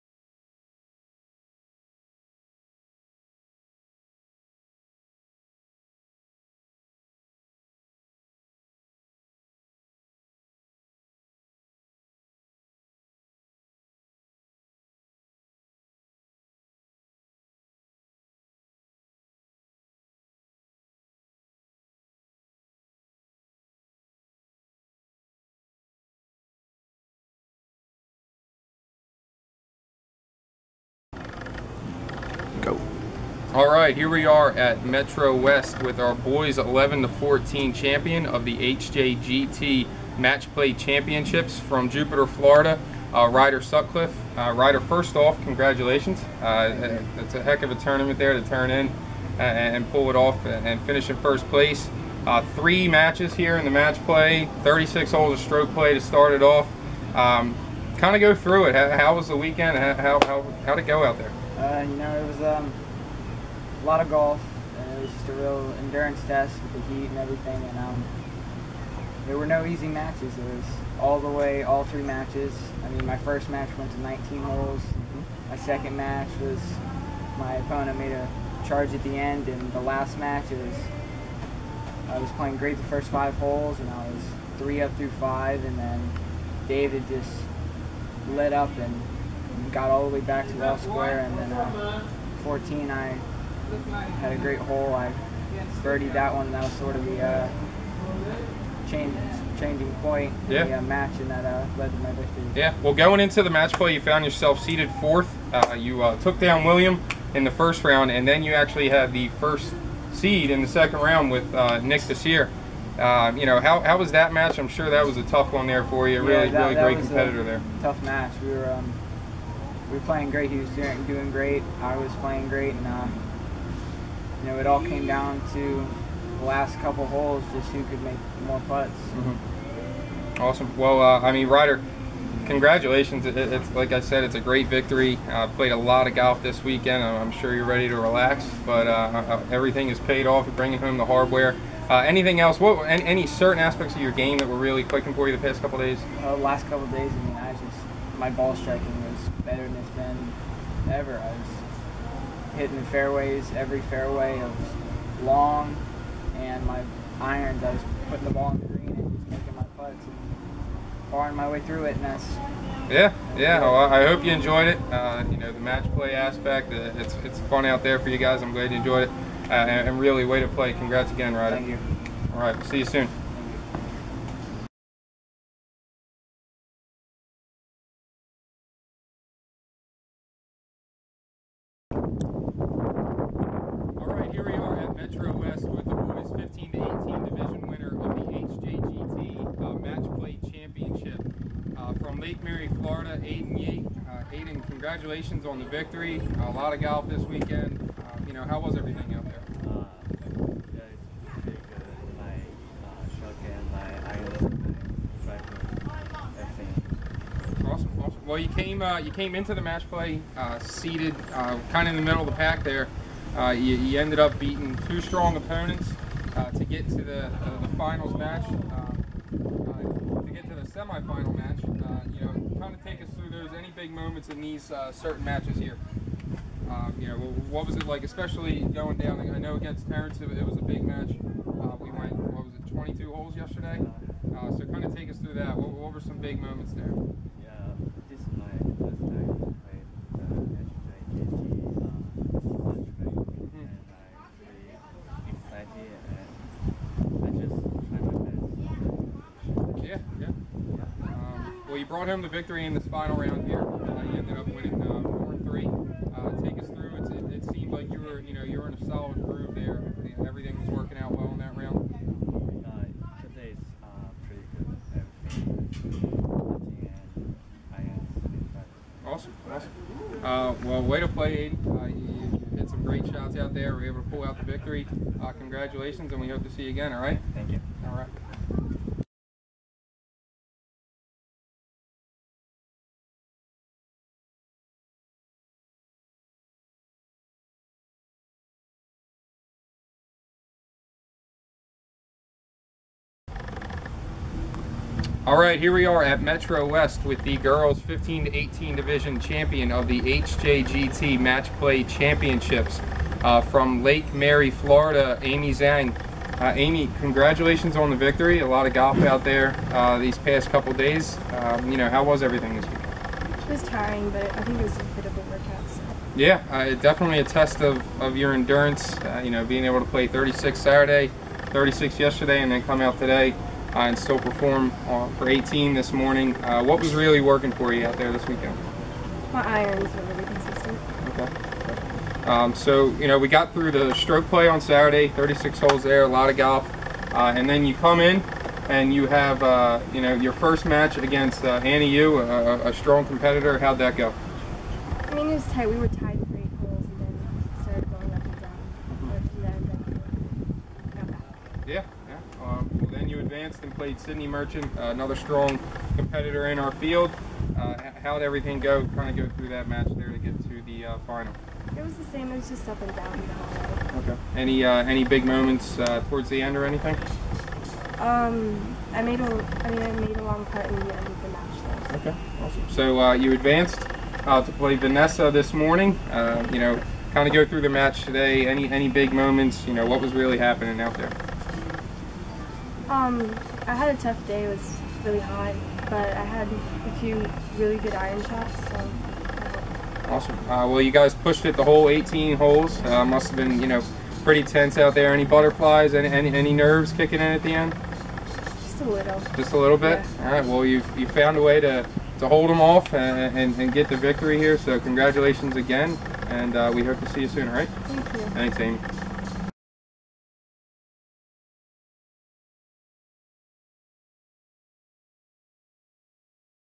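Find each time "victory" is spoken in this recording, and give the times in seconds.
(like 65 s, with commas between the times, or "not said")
102 s, 134 s, 195 s, 252 s, 274 s, 307 s, 403 s.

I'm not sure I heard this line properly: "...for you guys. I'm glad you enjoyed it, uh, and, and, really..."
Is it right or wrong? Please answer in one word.
right.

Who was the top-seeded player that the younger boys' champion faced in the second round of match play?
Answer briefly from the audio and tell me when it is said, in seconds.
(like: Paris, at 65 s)
Nick Desir, at 111 s.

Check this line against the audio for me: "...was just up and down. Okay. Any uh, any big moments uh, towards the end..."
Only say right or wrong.
right.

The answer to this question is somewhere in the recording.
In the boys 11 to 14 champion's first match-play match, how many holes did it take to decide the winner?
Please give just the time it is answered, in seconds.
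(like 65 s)
74 s.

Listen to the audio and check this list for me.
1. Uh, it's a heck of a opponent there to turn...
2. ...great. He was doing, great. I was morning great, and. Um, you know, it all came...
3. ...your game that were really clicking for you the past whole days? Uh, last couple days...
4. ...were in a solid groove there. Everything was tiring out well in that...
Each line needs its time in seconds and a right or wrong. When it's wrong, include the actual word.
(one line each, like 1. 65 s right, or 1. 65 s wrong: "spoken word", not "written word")
1. 46 s wrong: "tournament", not "opponent"
2. 120 s wrong: "playing", not "morning"
3. 144 s wrong: "couple", not "whole"
4. 258 s wrong: "working", not "tiring".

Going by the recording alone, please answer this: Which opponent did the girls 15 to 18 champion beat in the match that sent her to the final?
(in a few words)
Sydney Merchant.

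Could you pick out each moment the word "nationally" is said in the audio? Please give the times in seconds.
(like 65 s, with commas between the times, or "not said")
not said.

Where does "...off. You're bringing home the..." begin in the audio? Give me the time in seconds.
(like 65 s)
140 s.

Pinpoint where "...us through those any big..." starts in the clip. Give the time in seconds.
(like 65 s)
223 s.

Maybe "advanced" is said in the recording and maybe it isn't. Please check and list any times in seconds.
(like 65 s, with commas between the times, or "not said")
353 s, 373 s.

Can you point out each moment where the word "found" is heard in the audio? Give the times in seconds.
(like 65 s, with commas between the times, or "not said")
104 s, 401 s.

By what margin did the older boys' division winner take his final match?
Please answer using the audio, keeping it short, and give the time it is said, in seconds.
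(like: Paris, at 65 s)
4 and 3, at 255 s.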